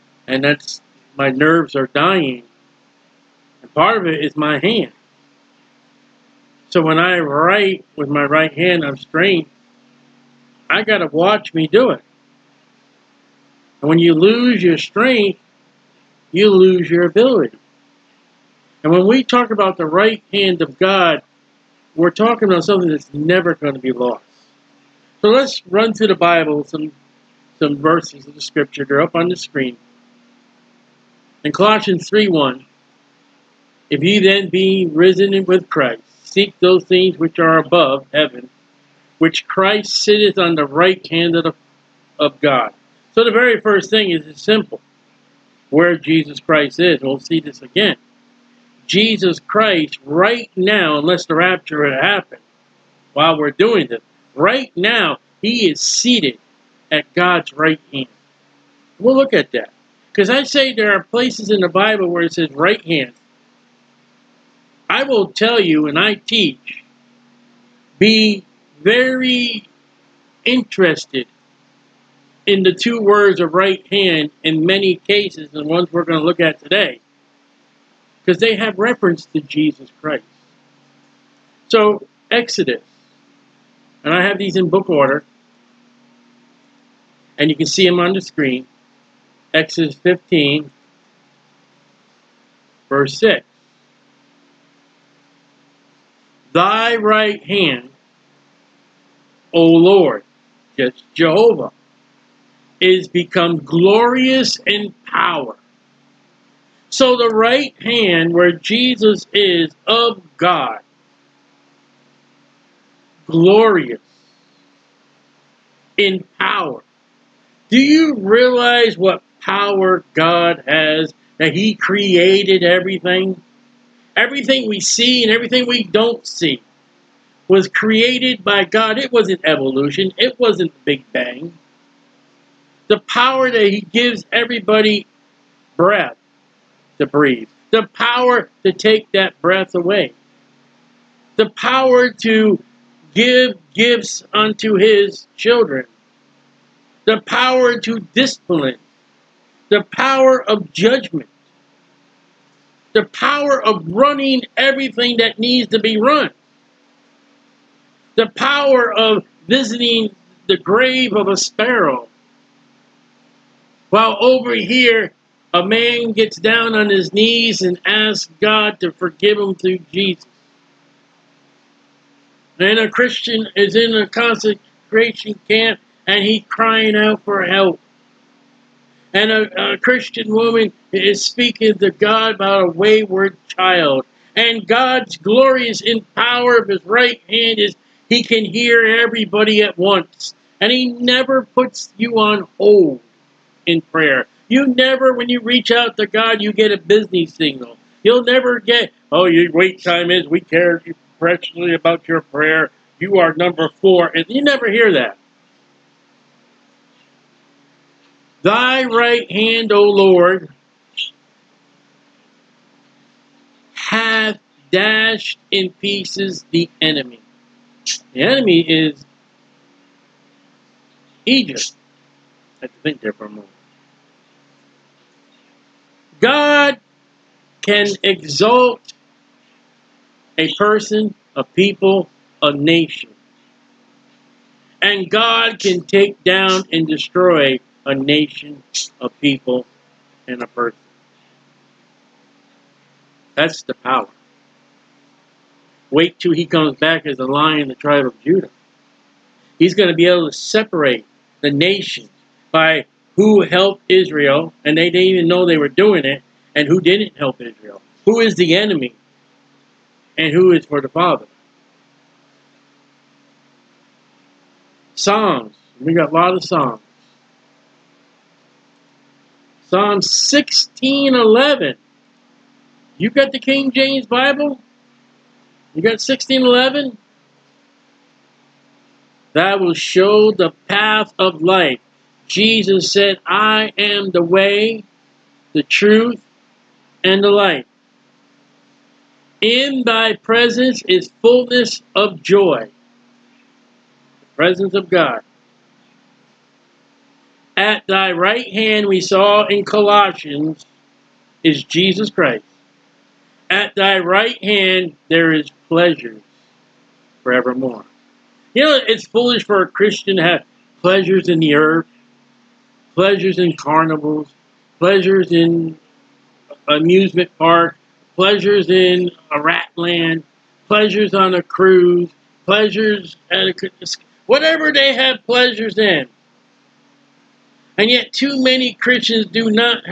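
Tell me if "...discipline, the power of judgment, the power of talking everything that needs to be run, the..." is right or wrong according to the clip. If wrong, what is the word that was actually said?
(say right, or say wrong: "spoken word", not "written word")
wrong: "running", not "talking".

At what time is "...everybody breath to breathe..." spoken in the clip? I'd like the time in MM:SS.
02:14.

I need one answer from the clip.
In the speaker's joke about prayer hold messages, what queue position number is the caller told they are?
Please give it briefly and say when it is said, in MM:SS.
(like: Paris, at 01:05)
4, at 03:23.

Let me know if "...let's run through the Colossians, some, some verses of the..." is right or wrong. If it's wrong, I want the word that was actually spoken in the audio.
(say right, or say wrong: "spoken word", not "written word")
wrong: "Bible", not "Colossians".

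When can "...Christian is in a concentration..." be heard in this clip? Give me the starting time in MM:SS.
02:52.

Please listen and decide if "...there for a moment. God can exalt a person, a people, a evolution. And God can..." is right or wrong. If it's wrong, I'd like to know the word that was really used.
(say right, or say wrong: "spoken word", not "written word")
wrong: "nation", not "evolution".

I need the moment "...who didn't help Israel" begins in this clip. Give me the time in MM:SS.
04:16.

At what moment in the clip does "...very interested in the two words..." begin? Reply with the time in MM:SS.
01:08.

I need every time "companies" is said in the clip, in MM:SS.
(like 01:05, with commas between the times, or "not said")
not said.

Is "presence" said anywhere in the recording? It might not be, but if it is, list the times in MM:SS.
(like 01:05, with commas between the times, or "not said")
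04:50, 04:54.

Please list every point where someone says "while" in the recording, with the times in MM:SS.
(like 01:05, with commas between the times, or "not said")
00:53, 02:43.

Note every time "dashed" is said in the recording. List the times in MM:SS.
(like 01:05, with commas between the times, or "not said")
03:34.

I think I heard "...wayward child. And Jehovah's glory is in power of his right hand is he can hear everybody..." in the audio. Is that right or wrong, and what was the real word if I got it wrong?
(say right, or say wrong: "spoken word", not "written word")
wrong: "God", not "Jehovah".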